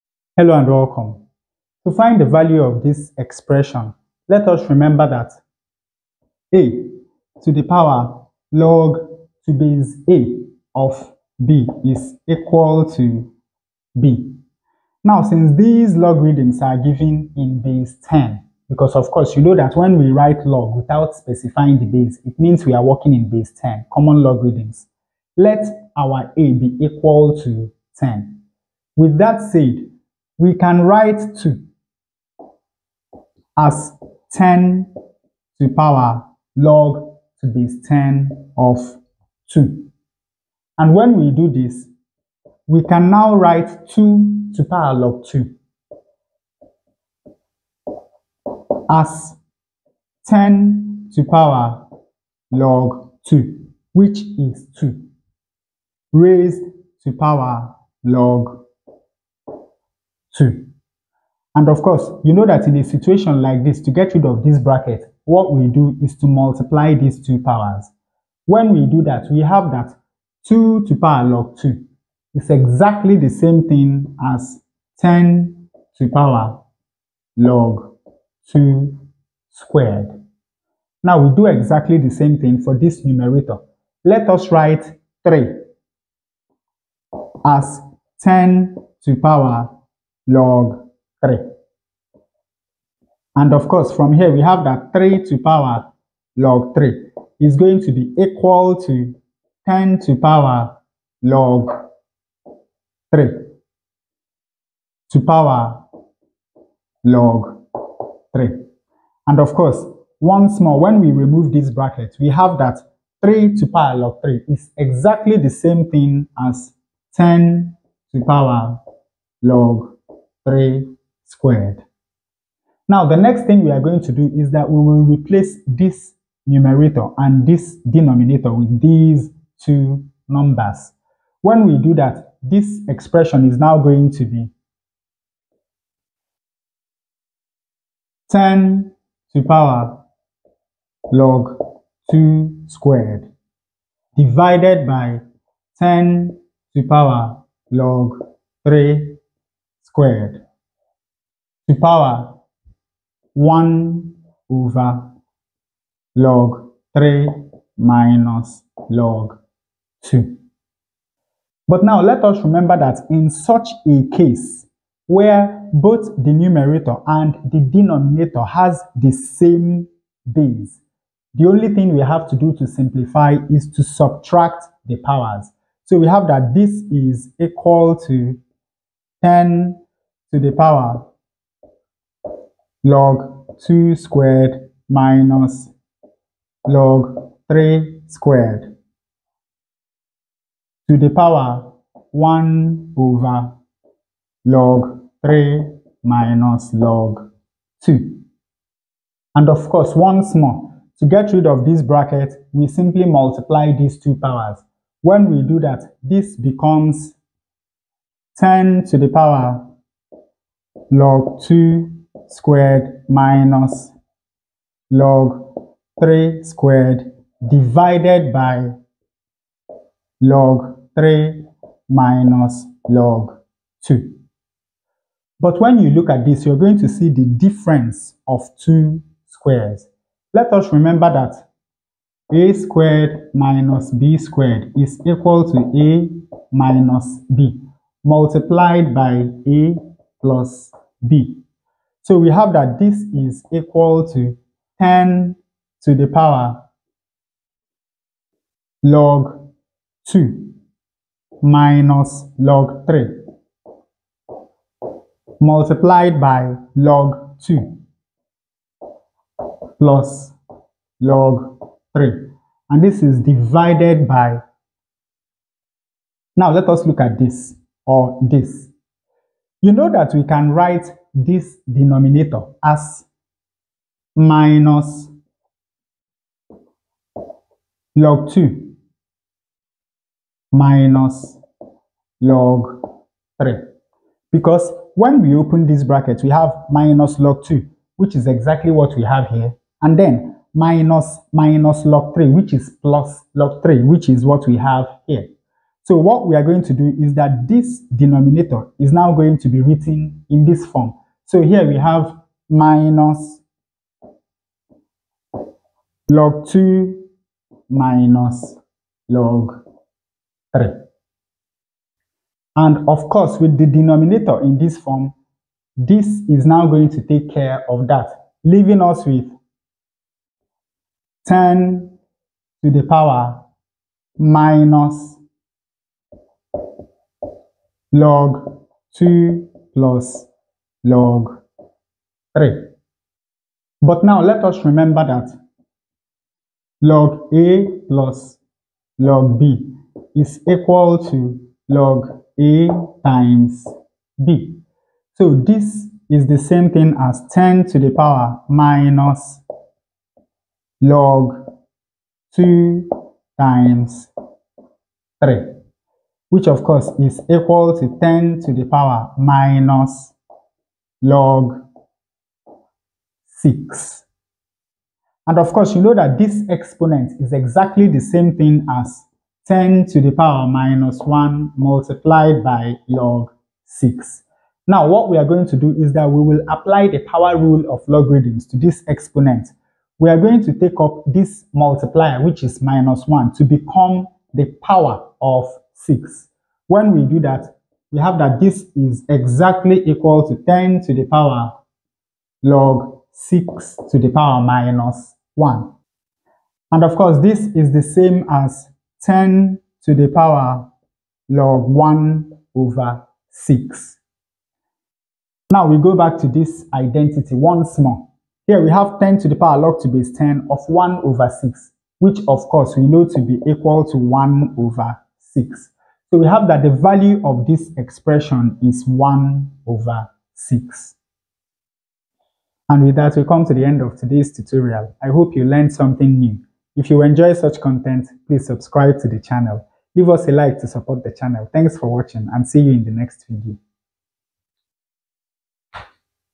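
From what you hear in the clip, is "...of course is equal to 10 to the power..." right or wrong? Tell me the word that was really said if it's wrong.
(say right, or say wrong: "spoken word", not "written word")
right.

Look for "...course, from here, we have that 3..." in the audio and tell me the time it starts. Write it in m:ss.
1:33.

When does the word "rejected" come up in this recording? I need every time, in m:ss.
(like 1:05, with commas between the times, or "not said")
not said.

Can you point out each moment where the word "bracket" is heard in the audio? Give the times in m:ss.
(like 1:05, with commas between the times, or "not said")
1:04, 1:51, 3:21, 4:45.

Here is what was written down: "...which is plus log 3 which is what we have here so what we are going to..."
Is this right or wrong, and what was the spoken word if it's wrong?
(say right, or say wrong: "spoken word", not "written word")
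right.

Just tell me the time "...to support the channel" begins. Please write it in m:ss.
7:10.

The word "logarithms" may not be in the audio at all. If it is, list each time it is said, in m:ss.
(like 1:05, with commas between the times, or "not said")
0:15, 0:24, 6:17.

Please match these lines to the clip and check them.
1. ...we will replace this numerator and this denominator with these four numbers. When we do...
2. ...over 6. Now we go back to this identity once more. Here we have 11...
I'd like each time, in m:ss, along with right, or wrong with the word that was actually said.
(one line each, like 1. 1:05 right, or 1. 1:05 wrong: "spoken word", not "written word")
1. 2:04 wrong: "two", not "four"
2. 6:42 wrong: "10", not "11".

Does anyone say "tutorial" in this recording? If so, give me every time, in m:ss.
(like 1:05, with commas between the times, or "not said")
7:04.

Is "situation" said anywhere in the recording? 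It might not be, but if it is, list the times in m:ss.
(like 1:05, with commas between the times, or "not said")
1:02.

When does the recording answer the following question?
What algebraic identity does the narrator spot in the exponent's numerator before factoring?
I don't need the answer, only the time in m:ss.
3:47.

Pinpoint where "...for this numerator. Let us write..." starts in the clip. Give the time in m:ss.
1:22.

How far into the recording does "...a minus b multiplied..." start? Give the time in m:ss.
3:55.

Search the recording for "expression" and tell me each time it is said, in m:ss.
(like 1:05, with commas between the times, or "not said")
0:03, 2:12, 6:57.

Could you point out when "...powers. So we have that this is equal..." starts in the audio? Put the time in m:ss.
2:55.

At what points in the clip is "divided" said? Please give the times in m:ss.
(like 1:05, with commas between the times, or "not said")
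2:24, 3:37, 4:23.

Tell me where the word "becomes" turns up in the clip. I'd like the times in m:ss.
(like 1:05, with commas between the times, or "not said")
3:26, 6:23.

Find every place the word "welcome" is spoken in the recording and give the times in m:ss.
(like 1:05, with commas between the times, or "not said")
0:00.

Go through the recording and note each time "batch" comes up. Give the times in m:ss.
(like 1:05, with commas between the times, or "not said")
not said.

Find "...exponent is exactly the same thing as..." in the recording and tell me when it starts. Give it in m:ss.
6:06.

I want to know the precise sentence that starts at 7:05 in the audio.
I hope you learned something new.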